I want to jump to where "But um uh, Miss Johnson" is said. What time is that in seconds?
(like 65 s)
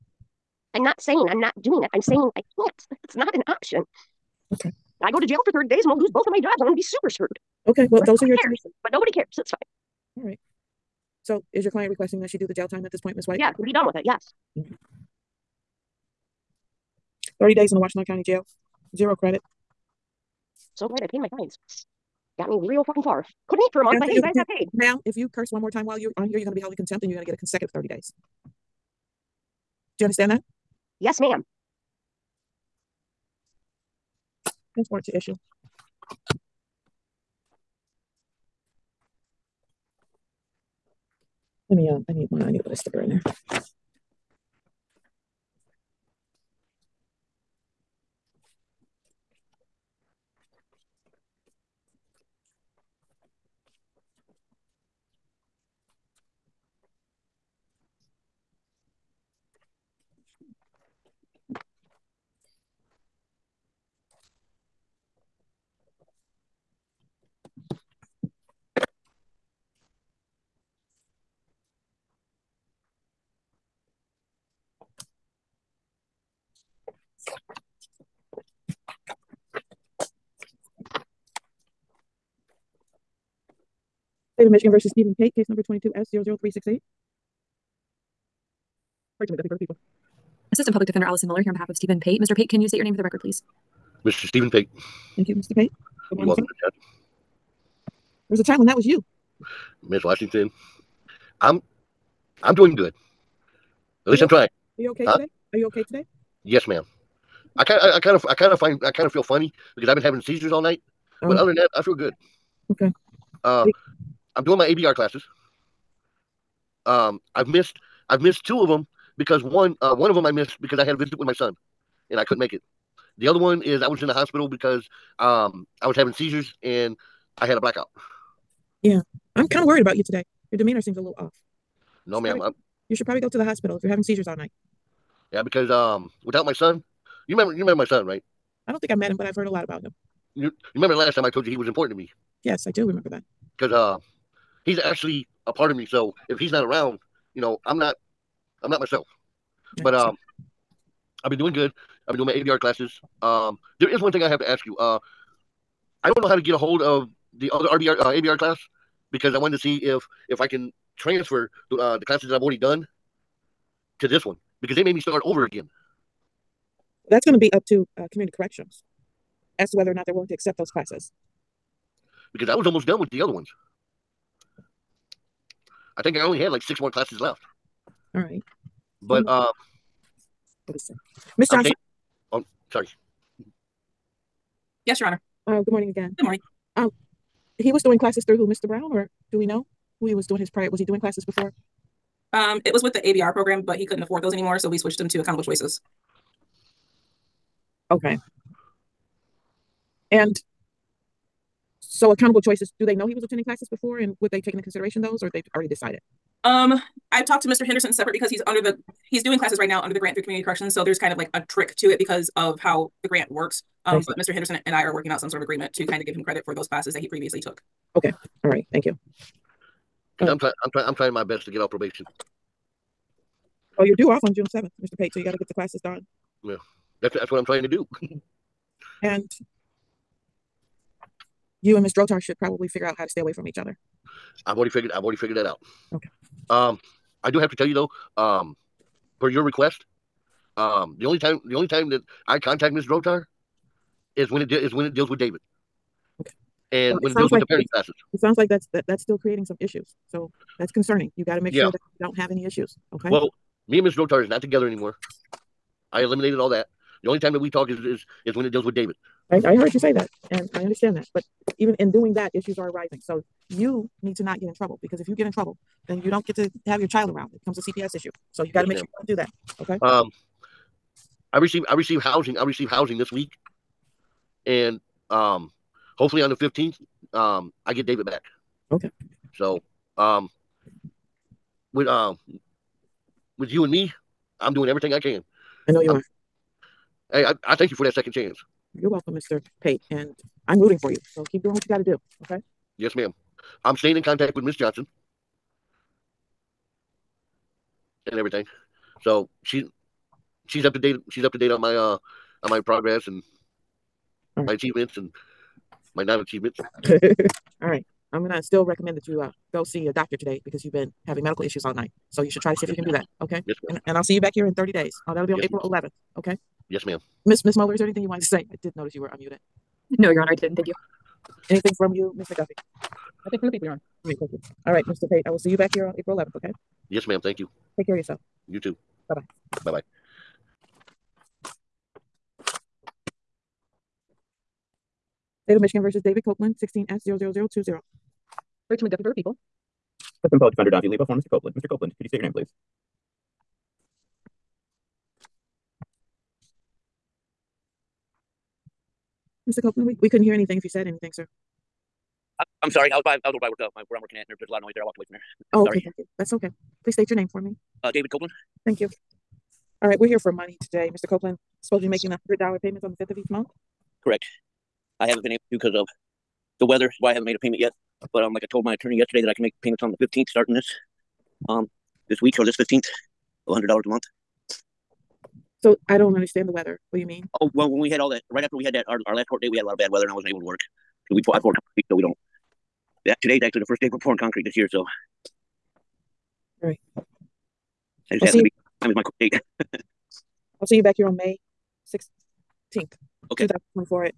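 179 s.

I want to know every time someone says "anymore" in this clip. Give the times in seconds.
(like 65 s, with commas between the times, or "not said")
194 s, 254 s.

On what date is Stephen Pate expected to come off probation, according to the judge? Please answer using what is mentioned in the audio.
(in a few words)
June 7.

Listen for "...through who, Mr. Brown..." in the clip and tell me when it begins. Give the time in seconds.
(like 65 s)
188 s.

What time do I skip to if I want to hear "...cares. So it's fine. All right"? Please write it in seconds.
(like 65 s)
9 s.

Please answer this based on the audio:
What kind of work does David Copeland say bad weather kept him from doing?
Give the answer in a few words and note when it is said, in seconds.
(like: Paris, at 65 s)
pouring concrete, at 381 s.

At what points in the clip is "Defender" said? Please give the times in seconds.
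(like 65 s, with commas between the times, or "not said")
90 s, 340 s.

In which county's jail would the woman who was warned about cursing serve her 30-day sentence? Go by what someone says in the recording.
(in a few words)
Washtenaw County.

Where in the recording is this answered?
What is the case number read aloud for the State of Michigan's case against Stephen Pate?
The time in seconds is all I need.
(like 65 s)
85 s.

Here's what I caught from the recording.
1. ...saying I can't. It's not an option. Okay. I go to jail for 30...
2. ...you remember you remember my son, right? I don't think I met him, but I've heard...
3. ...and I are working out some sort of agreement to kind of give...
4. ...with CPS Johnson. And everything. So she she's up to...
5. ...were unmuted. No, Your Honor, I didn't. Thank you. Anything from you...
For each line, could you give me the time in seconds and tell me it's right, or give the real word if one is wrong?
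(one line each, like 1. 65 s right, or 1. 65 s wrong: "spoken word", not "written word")
1. 2 s right
2. 137 s right
3. 214 s right
4. 294 s wrong: "Miss", not "CPS"
5. 319 s right.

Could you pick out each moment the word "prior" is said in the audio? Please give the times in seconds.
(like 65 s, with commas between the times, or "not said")
190 s.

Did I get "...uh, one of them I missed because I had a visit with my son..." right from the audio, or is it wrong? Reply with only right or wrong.
right.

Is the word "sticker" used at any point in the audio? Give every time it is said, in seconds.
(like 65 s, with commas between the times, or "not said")
42 s.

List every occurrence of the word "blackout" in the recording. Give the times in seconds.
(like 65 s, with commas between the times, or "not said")
127 s.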